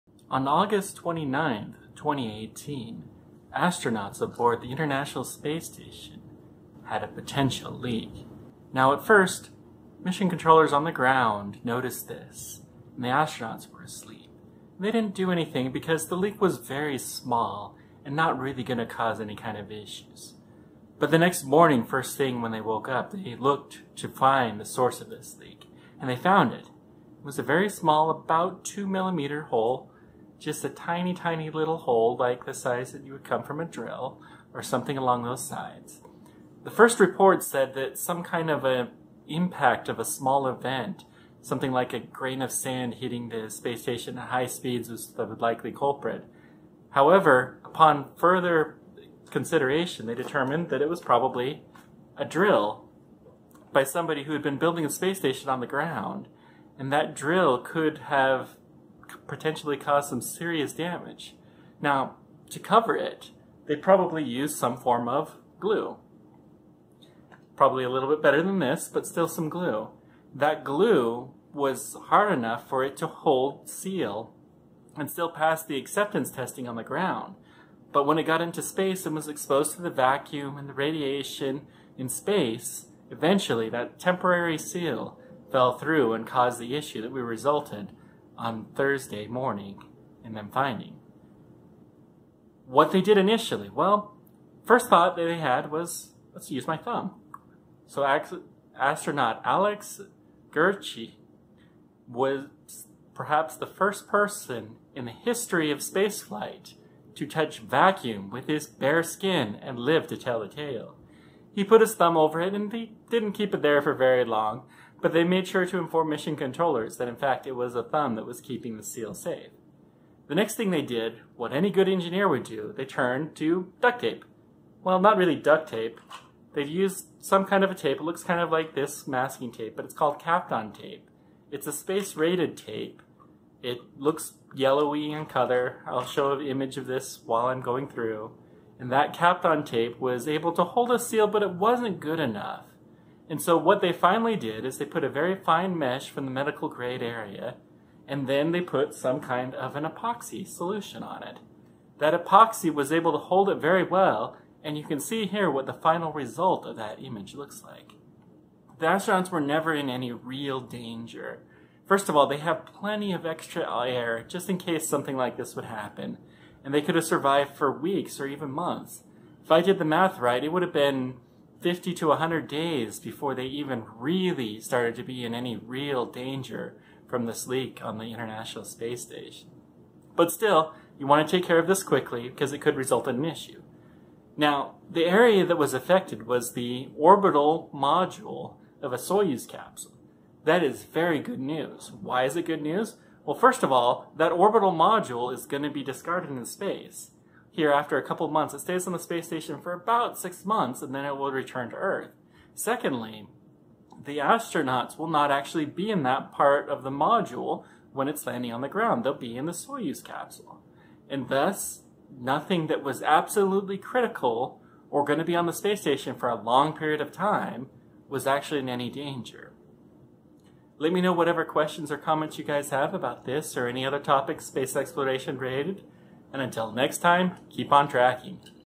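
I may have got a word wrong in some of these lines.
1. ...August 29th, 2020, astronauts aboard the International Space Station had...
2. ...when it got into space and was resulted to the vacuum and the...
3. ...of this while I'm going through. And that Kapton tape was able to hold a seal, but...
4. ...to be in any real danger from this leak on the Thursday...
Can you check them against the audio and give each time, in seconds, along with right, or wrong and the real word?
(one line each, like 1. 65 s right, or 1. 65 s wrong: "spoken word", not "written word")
1. 0 s wrong: "2018", not "2020"
2. 78 s wrong: "exposed", not "resulted"
3. 136 s right
4. 174 s wrong: "International", not "Thursday".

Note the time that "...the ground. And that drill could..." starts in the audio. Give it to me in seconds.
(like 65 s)
55 s.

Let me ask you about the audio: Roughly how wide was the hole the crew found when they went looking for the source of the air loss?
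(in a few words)
2 millimeters.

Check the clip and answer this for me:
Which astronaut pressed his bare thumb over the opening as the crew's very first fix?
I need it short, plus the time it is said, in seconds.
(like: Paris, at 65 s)
Alex Gerst, at 99 s.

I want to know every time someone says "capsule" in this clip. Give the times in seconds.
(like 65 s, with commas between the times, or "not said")
189 s, 210 s.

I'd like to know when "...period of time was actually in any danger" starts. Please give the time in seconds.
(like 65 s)
216 s.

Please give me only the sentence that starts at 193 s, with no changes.
Well, first of all, that orbital module is going to be discarded in space.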